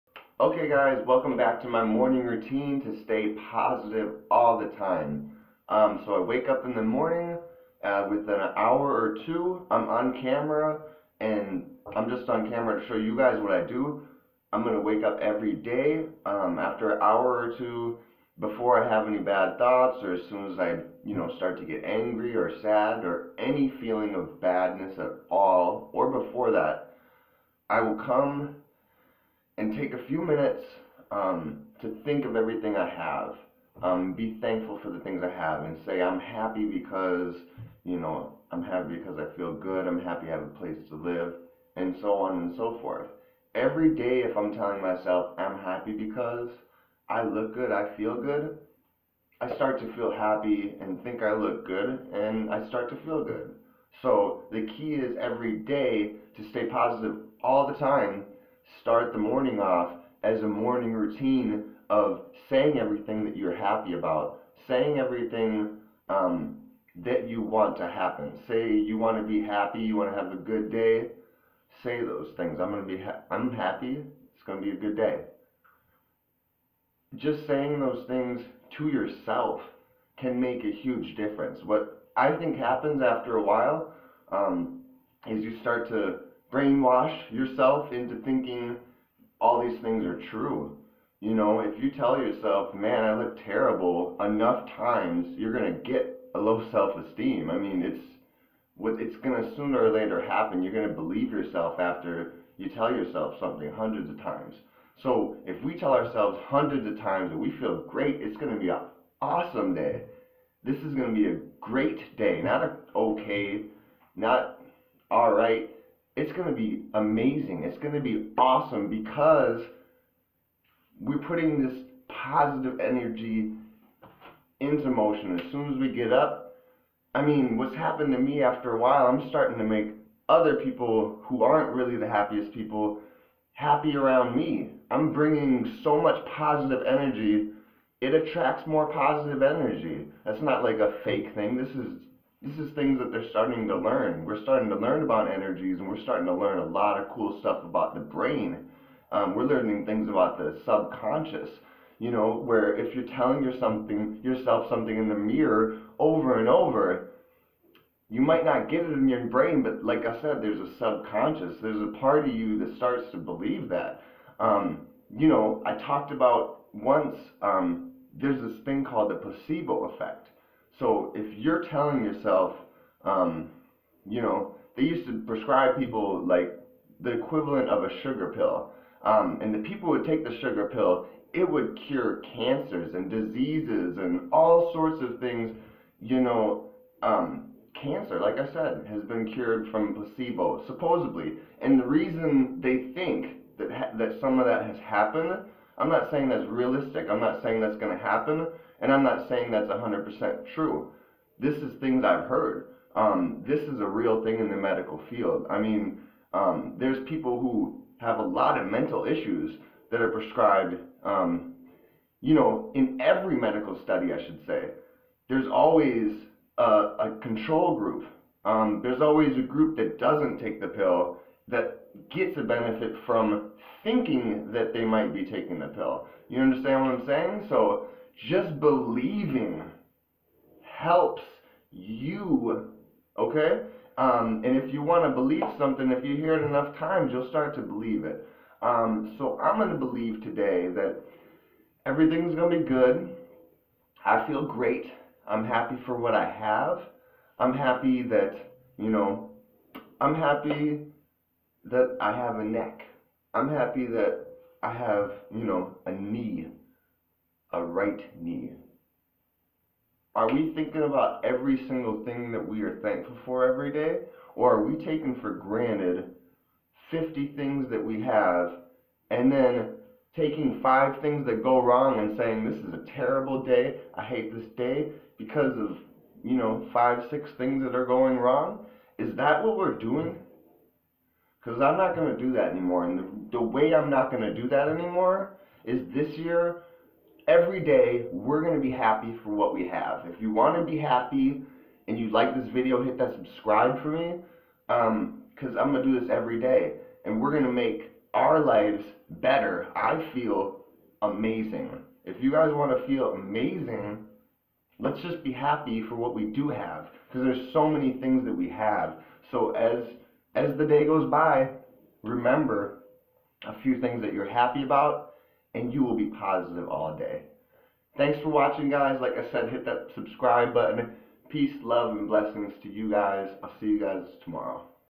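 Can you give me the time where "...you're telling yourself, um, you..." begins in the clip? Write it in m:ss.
2:51.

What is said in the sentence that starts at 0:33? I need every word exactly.
Um, be thankful for the things I have and say, I'm happy because, you know, I'm happy because I feel good.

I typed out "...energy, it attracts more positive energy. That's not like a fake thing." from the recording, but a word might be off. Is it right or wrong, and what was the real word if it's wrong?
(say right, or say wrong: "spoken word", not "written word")
right.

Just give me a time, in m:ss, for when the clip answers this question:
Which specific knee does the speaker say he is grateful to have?
4:17.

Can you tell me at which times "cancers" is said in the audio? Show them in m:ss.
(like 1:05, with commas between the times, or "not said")
3:02, 3:07.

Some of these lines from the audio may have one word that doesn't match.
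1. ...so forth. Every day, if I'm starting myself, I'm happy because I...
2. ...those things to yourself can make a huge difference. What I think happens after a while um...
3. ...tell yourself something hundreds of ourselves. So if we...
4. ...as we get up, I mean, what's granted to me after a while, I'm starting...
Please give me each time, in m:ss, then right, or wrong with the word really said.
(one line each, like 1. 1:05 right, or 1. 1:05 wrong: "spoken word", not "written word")
1. 0:42 wrong: "telling", not "starting"
2. 1:17 right
3. 1:42 wrong: "times", not "ourselves"
4. 2:05 wrong: "happened", not "granted".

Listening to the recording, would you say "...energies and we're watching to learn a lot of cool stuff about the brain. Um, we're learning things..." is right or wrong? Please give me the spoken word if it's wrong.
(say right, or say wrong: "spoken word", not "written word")
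wrong: "starting", not "watching".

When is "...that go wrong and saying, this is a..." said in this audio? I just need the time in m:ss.
4:31.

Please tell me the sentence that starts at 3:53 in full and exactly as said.
Um, and if you want to believe something, if you hear it enough times, you'll start to believe it.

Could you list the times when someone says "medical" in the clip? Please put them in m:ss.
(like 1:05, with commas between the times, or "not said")
3:24, 3:33.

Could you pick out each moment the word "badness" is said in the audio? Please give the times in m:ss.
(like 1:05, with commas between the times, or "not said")
0:24.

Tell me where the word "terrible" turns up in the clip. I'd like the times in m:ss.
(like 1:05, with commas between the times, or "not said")
1:33, 4:32.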